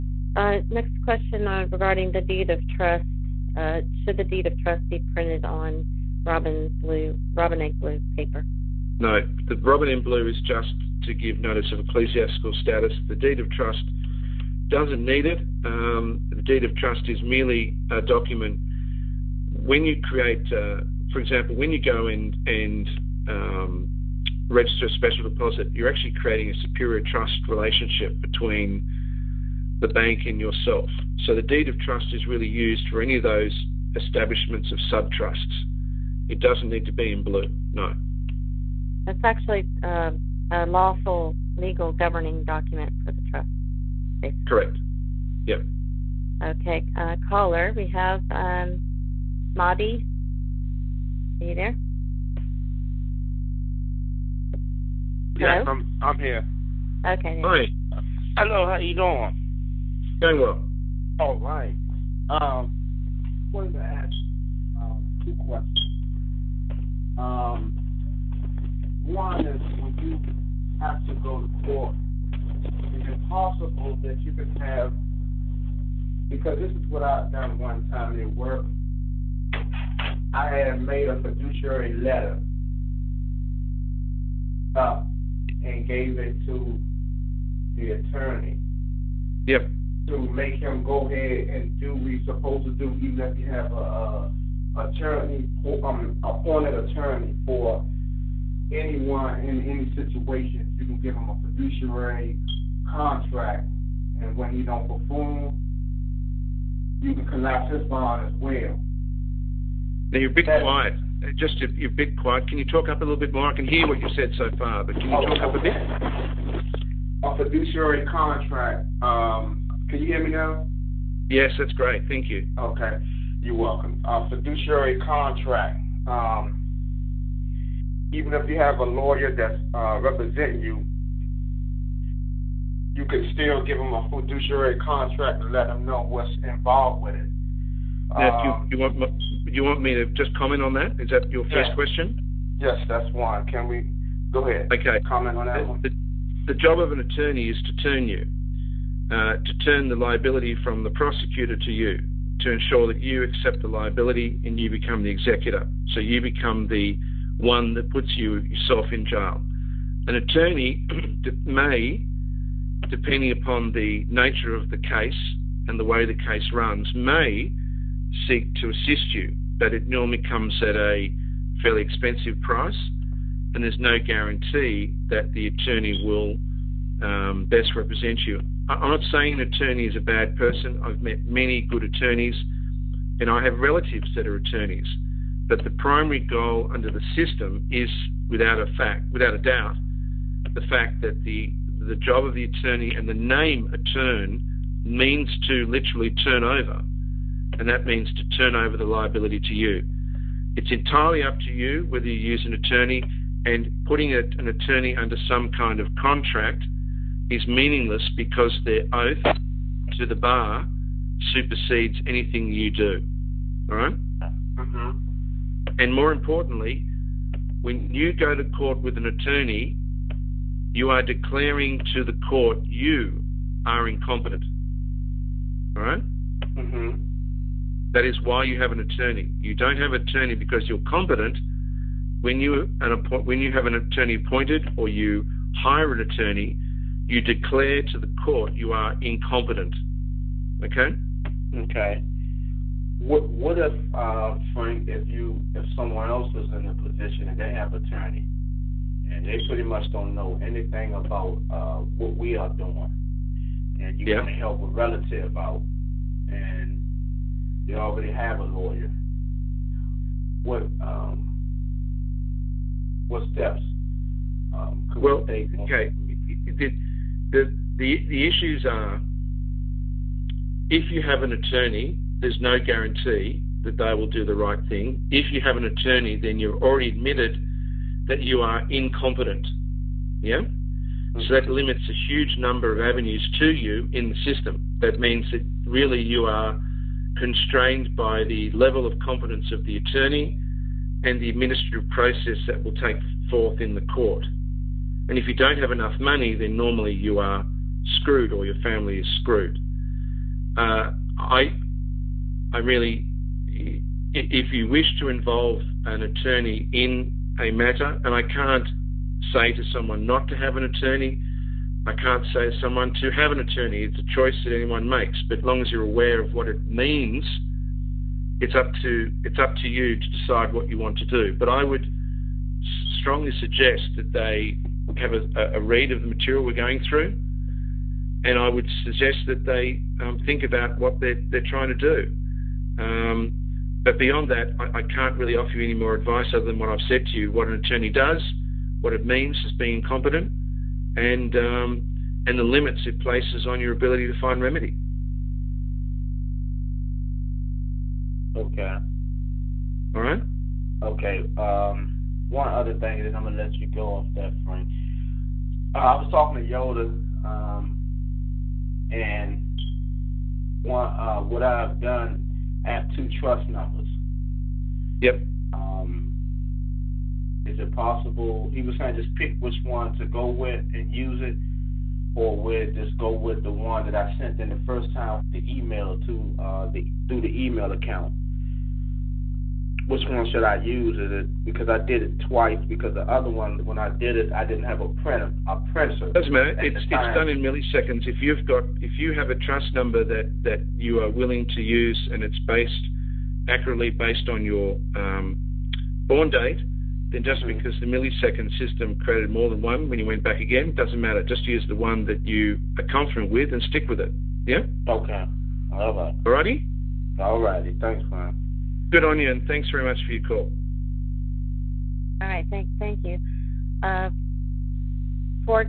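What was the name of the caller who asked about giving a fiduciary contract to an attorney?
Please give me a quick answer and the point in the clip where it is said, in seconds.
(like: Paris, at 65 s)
Mahdi, at 49 s.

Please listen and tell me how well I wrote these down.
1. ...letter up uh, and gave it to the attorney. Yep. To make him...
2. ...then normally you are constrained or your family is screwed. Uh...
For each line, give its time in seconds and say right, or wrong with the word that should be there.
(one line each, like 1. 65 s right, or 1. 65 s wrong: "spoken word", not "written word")
1. 81 s right
2. 296 s wrong: "screwed", not "constrained".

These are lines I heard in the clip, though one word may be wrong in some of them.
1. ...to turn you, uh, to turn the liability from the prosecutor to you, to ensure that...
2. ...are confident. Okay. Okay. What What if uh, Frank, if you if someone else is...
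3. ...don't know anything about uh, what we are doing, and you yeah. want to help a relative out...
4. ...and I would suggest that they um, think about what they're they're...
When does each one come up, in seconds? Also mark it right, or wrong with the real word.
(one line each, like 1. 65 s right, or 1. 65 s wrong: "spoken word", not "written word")
1. 147 s right
2. 238 s wrong: "incompetent", not "confident"
3. 249 s right
4. 328 s right.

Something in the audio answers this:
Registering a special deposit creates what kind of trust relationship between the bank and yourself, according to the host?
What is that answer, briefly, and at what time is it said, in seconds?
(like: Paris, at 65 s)
Superior trust, at 26 s.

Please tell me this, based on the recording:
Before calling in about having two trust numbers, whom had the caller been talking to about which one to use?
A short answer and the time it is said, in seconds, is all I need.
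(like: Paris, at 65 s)
Yoda, at 356 s.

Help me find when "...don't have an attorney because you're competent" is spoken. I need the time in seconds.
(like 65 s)
229 s.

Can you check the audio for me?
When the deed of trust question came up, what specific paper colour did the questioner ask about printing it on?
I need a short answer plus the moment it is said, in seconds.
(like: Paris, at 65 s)
Robin egg blue, at 7 s.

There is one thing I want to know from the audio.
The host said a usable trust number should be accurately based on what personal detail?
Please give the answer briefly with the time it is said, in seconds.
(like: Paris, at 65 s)
Born date, at 396 s.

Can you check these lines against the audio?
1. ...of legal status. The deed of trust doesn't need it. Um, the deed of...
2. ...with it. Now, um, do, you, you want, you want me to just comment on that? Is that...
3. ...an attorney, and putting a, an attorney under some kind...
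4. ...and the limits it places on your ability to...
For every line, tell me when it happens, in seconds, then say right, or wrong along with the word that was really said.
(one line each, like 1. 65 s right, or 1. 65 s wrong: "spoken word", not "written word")
1. 11 s wrong: "ecclesiastical", not "legal"
2. 137 s right
3. 202 s right
4. 342 s right.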